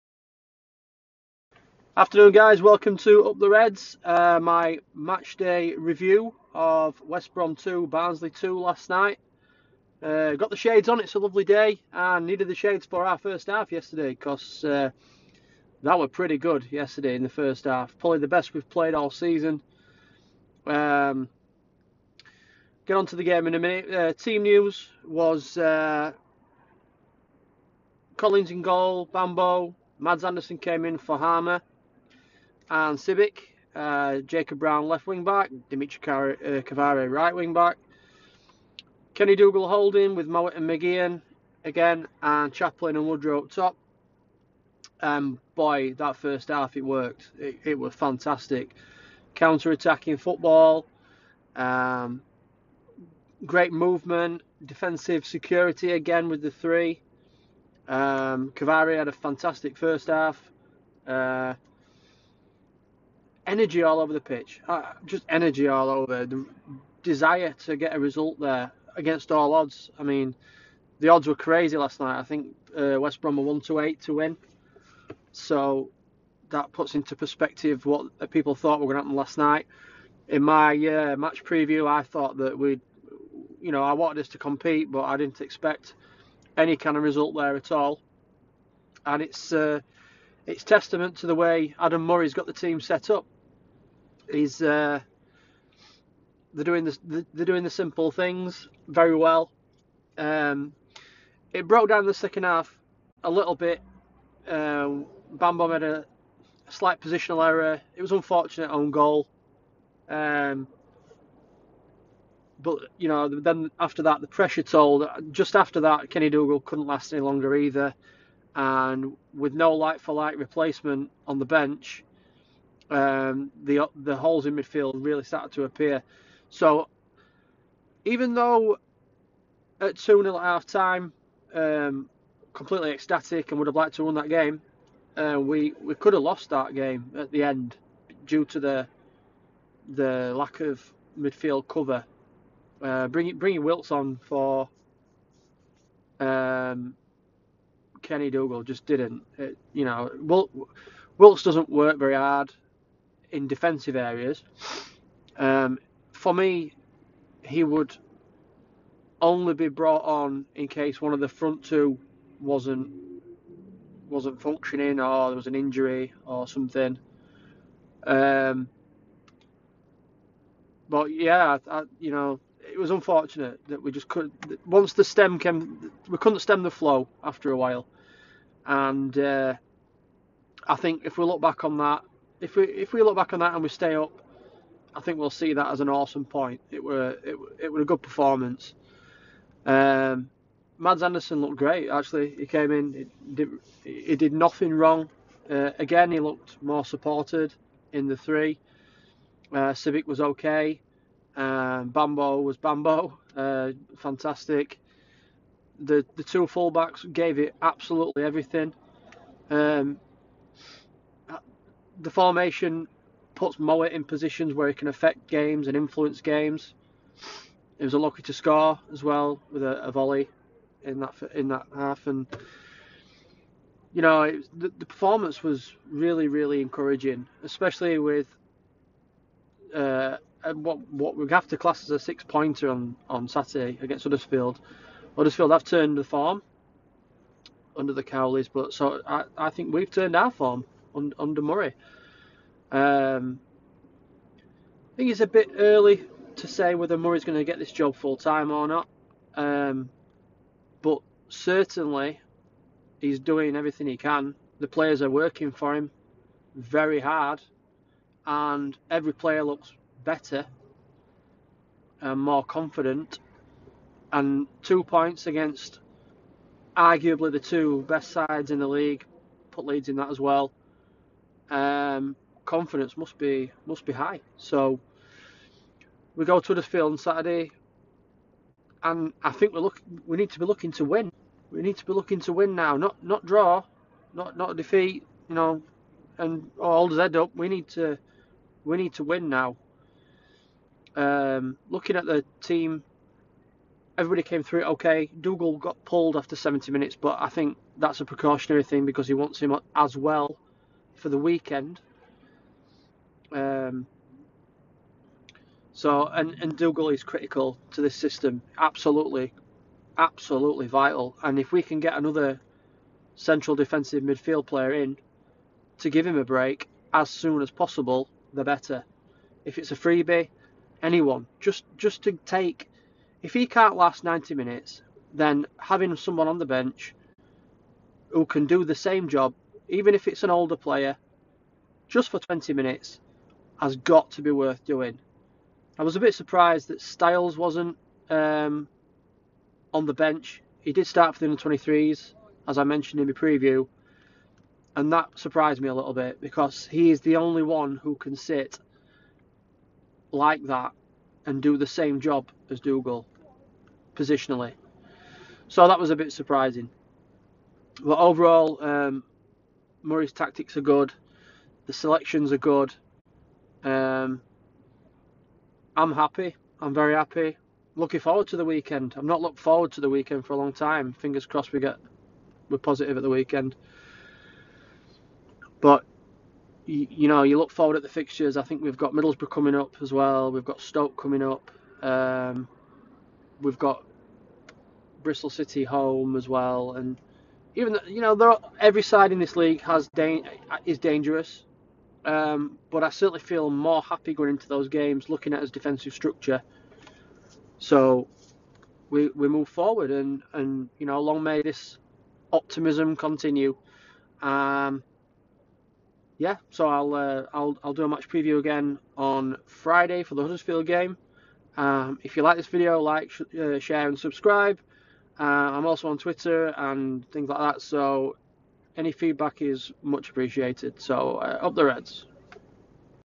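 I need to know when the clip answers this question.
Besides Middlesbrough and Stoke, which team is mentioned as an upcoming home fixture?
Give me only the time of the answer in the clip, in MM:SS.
06:25.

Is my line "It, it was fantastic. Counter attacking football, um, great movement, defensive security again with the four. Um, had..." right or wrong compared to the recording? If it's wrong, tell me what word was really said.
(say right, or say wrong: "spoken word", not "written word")
wrong: "three", not "four".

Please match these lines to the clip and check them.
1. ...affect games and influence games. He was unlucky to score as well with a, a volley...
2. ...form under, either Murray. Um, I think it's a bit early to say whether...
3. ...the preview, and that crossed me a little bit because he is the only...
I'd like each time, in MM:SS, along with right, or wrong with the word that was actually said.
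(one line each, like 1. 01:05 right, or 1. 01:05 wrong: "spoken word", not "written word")
1. 03:34 right
2. 04:00 wrong: "under", not "either"
3. 05:43 wrong: "surprised", not "crossed".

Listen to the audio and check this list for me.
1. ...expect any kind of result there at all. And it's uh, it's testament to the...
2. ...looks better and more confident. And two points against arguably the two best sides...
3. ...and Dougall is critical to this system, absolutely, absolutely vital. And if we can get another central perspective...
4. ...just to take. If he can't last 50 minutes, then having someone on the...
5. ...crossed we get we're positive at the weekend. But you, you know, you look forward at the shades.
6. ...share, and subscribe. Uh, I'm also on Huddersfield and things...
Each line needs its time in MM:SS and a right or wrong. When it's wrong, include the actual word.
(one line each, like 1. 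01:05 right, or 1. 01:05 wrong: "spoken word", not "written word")
1. 01:25 right
2. 04:19 right
3. 05:06 wrong: "defensive", not "perspective"
4. 05:21 wrong: "90", not "50"
5. 06:11 wrong: "fixtures", not "shades"
6. 06:53 wrong: "Twitter", not "Huddersfield".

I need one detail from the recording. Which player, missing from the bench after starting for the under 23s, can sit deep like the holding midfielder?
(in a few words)
Styles.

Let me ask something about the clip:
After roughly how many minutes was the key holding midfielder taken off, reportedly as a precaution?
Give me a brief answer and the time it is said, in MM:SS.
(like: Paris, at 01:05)
70, at 04:56.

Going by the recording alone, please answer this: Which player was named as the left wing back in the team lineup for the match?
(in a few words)
Jacob Brown.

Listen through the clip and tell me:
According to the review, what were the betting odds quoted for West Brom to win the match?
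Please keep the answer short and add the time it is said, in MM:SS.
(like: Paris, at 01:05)
1 to 8, at 01:13.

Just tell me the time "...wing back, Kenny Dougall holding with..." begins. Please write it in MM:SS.
00:37.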